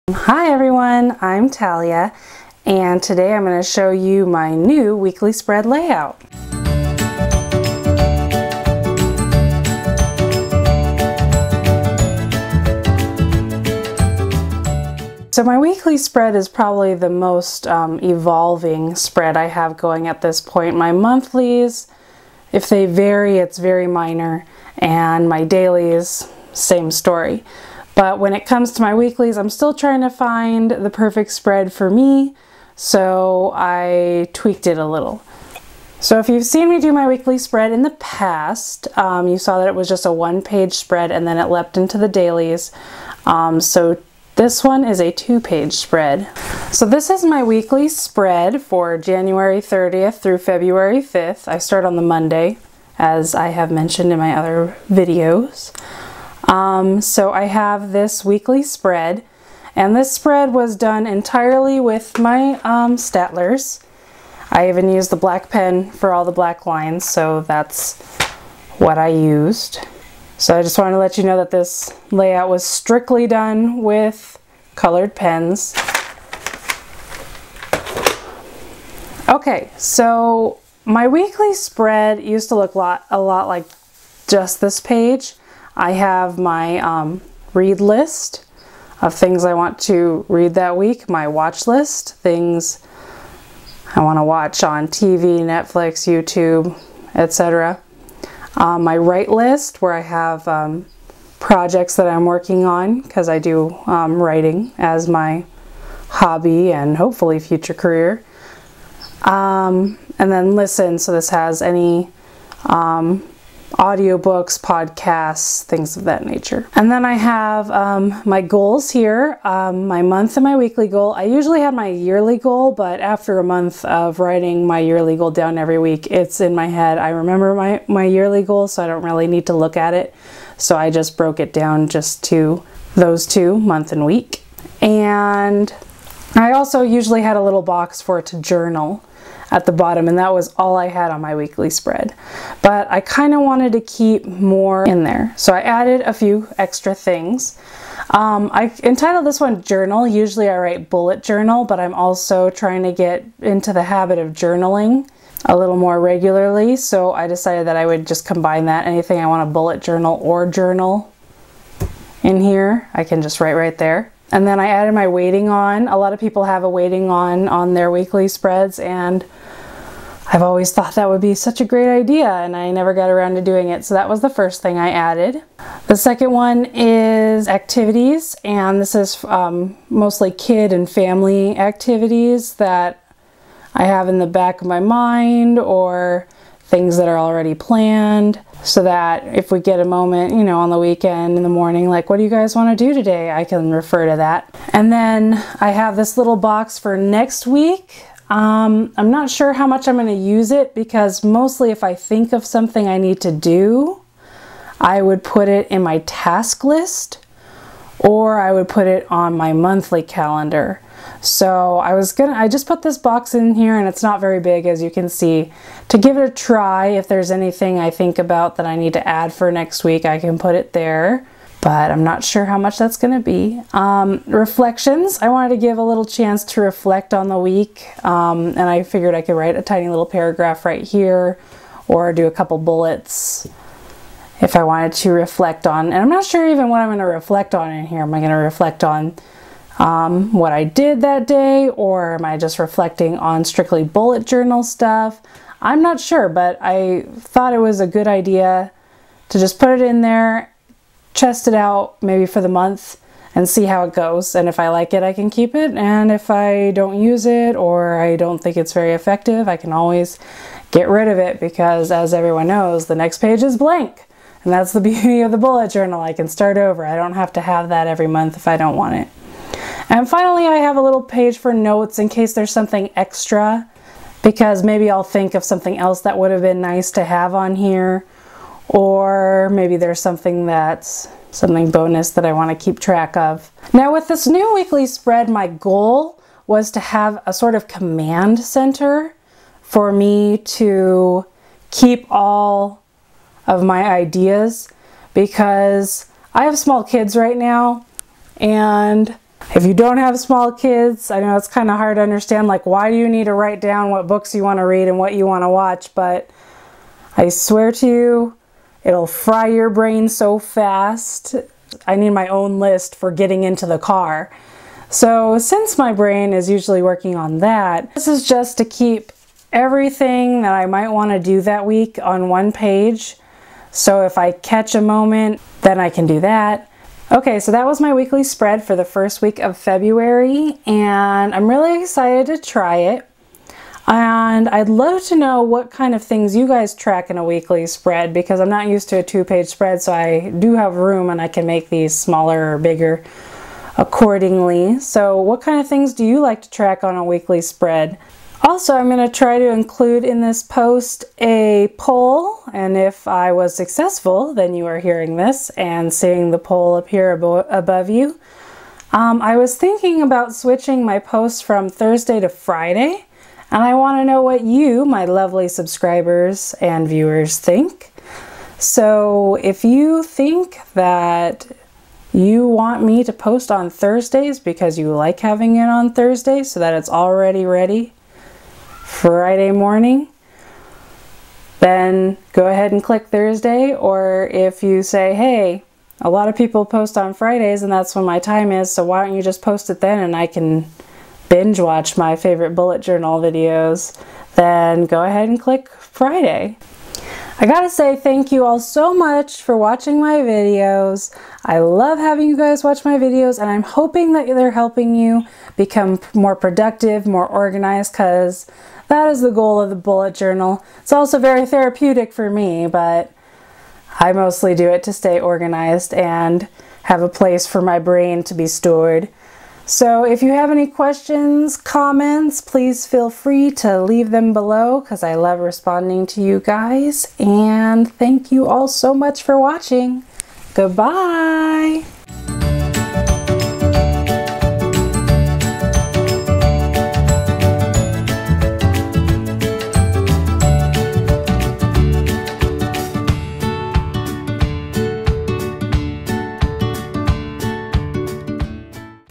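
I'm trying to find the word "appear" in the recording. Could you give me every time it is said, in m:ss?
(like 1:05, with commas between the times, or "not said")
5:56.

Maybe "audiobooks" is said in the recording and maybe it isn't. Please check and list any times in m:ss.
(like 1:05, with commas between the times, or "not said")
1:53.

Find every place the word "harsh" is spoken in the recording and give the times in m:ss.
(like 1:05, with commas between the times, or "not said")
not said.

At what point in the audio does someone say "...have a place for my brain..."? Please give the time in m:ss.
6:56.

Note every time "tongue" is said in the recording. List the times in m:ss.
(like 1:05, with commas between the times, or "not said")
not said.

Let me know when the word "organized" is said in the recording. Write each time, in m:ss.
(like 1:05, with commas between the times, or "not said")
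6:47, 6:55.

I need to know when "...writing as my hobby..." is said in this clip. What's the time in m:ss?
1:44.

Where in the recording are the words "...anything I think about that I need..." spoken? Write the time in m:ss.
3:37.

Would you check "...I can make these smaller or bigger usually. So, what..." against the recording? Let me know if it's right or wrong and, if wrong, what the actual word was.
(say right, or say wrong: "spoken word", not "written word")
wrong: "accordingly", not "usually".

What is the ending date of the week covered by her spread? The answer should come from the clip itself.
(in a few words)
February 5th.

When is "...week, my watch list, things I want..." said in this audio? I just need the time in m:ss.
1:30.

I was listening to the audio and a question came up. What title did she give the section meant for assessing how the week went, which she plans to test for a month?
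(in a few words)
Reflections.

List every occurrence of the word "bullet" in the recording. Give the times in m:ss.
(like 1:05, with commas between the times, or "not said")
2:30, 2:39, 3:52, 4:03, 4:25, 6:32, 6:49.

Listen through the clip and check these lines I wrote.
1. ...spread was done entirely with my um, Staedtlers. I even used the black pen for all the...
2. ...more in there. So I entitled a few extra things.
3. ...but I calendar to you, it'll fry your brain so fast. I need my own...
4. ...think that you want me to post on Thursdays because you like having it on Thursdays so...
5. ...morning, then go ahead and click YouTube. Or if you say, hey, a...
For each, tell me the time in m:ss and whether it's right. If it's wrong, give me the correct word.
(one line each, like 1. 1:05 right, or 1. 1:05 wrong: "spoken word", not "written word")
1. 1:00 right
2. 2:24 wrong: "added", not "entitled"
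3. 5:05 wrong: "swear", not "calendar"
4. 6:10 right
5. 6:19 wrong: "Thursday", not "YouTube".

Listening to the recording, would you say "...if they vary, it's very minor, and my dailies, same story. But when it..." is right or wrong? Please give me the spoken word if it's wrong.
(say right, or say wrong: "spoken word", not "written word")
right.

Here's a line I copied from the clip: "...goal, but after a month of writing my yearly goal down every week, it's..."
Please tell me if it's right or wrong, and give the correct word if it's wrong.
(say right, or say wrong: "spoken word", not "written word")
right.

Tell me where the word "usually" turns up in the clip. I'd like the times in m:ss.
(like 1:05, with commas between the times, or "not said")
2:01, 2:16, 2:30, 5:16.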